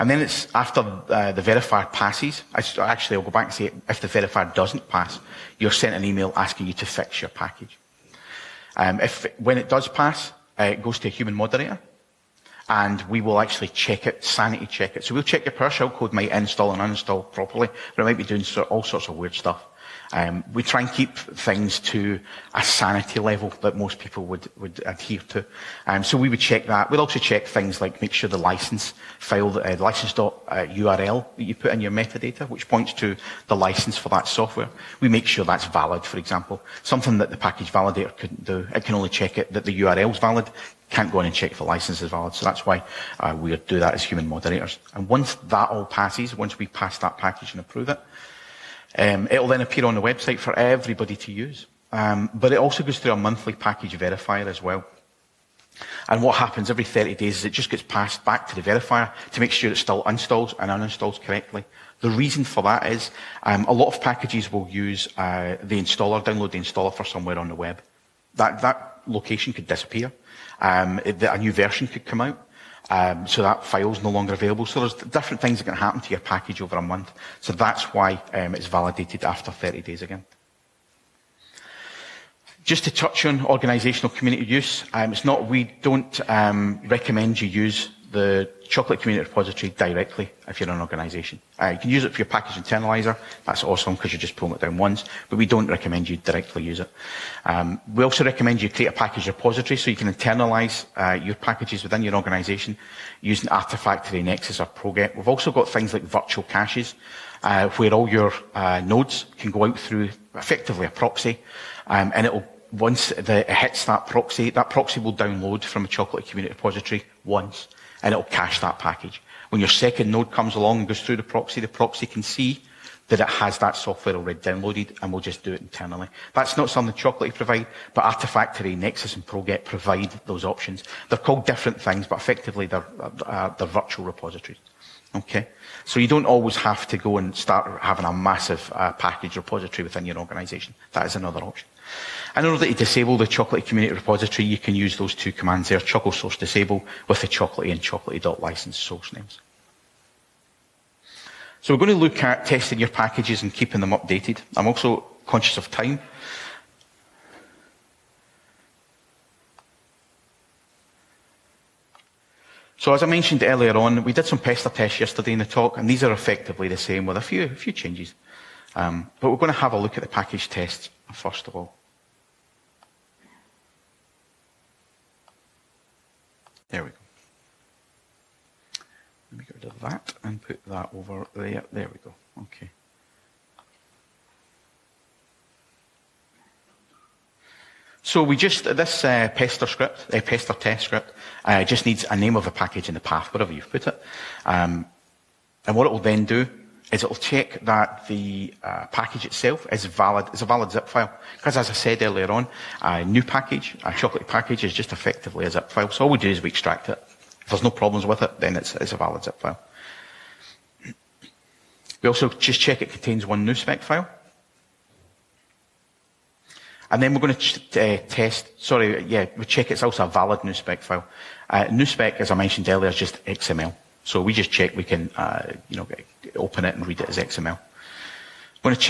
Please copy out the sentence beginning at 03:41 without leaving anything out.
Uh, nuspec, as I mentioned earlier, is just XML.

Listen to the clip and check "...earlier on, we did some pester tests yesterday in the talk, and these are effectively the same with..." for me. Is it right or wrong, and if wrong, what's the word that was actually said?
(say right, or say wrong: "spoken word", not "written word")
right.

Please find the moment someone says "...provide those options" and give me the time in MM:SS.
02:09.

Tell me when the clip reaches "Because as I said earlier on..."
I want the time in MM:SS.
03:21.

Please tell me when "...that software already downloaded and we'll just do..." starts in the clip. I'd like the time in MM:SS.
02:03.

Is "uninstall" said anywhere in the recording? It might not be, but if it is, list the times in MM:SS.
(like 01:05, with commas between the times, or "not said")
00:16, 01:00.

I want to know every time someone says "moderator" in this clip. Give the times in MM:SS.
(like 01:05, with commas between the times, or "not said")
00:11, 00:44.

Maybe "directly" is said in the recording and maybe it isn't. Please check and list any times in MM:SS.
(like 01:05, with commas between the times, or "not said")
01:29, 01:36.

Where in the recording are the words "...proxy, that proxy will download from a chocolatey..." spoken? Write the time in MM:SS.
01:54.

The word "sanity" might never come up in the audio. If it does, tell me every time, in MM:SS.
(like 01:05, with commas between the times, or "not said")
00:14, 00:22.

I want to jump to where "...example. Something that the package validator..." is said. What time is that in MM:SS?
00:36.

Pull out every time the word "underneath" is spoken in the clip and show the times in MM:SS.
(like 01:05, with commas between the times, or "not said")
not said.